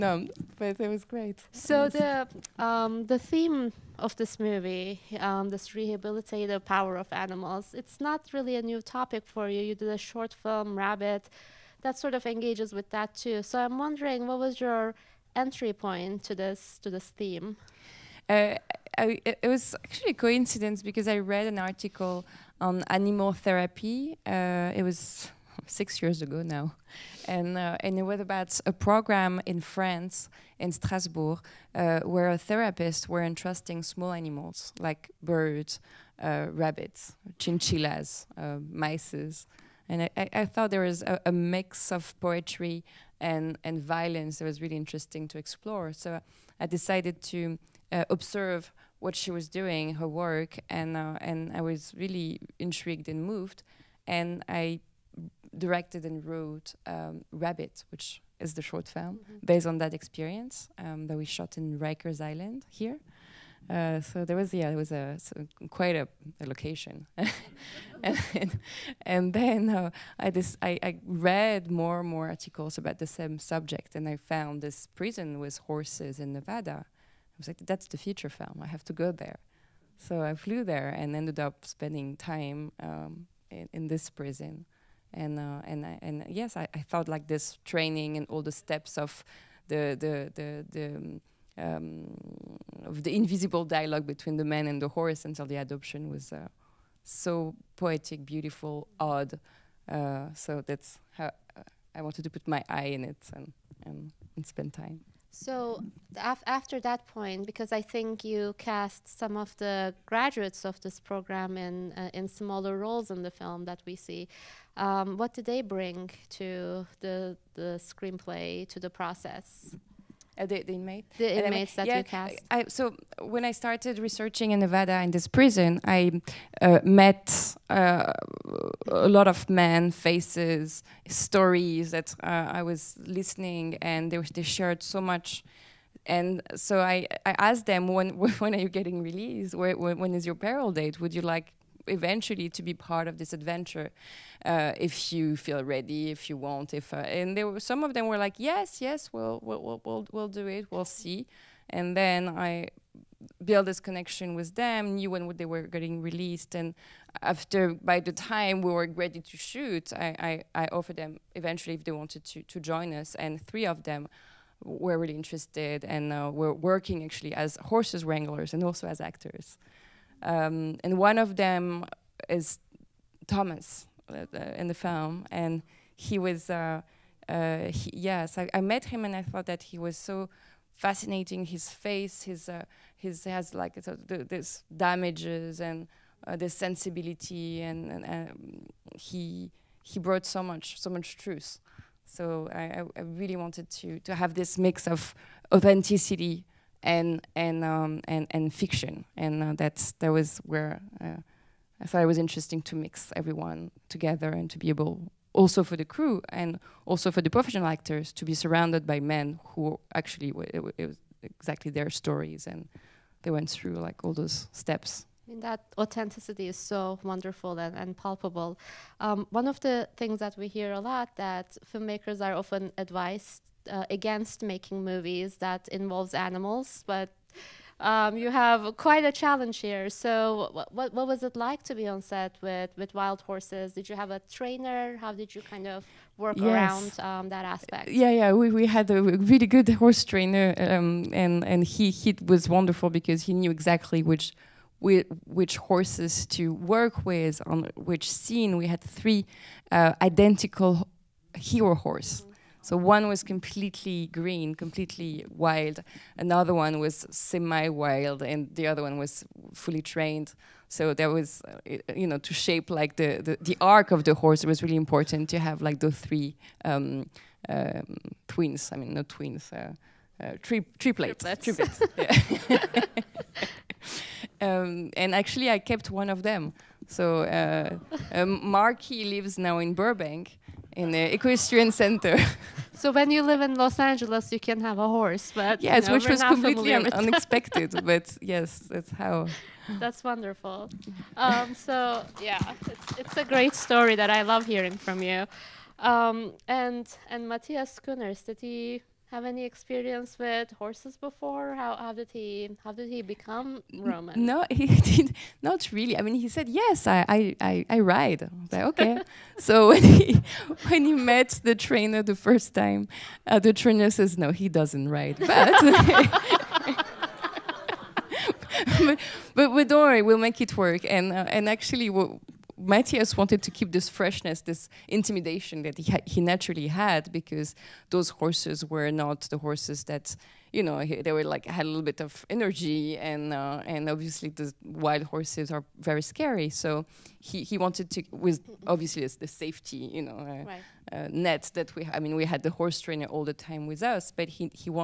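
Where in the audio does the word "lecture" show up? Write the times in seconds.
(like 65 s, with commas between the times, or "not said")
not said.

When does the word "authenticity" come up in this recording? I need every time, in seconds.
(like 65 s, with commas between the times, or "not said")
195 s, 215 s.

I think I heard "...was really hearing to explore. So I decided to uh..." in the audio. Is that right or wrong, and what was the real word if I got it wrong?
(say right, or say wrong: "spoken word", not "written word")
wrong: "interesting", not "hearing".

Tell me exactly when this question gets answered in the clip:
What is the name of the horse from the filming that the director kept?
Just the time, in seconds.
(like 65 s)
278 s.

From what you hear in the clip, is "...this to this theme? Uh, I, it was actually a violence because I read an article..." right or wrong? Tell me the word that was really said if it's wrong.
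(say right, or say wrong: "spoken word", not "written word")
wrong: "coincidence", not "violence".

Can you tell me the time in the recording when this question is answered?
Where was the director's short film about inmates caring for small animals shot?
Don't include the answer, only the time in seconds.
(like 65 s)
61 s.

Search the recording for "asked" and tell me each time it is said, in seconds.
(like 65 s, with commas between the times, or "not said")
137 s.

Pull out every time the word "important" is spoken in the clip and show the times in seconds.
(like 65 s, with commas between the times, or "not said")
264 s.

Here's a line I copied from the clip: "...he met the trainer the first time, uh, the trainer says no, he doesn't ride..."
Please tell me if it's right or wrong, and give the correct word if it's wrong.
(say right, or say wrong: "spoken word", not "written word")
right.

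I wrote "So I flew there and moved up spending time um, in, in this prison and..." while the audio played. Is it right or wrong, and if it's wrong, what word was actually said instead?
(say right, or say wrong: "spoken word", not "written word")
wrong: "ended", not "moved".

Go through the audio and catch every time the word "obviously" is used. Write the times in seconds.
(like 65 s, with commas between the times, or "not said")
333 s, 338 s.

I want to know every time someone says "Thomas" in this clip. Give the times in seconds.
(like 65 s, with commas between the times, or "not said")
173 s.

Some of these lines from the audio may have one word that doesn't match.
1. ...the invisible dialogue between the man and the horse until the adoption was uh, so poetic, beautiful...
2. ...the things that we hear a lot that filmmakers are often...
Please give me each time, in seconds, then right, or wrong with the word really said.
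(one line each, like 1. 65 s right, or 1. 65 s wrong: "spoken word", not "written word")
1. 93 s right
2. 219 s right.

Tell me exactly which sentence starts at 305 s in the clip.
I mean, he said yes, I I, I, I ride.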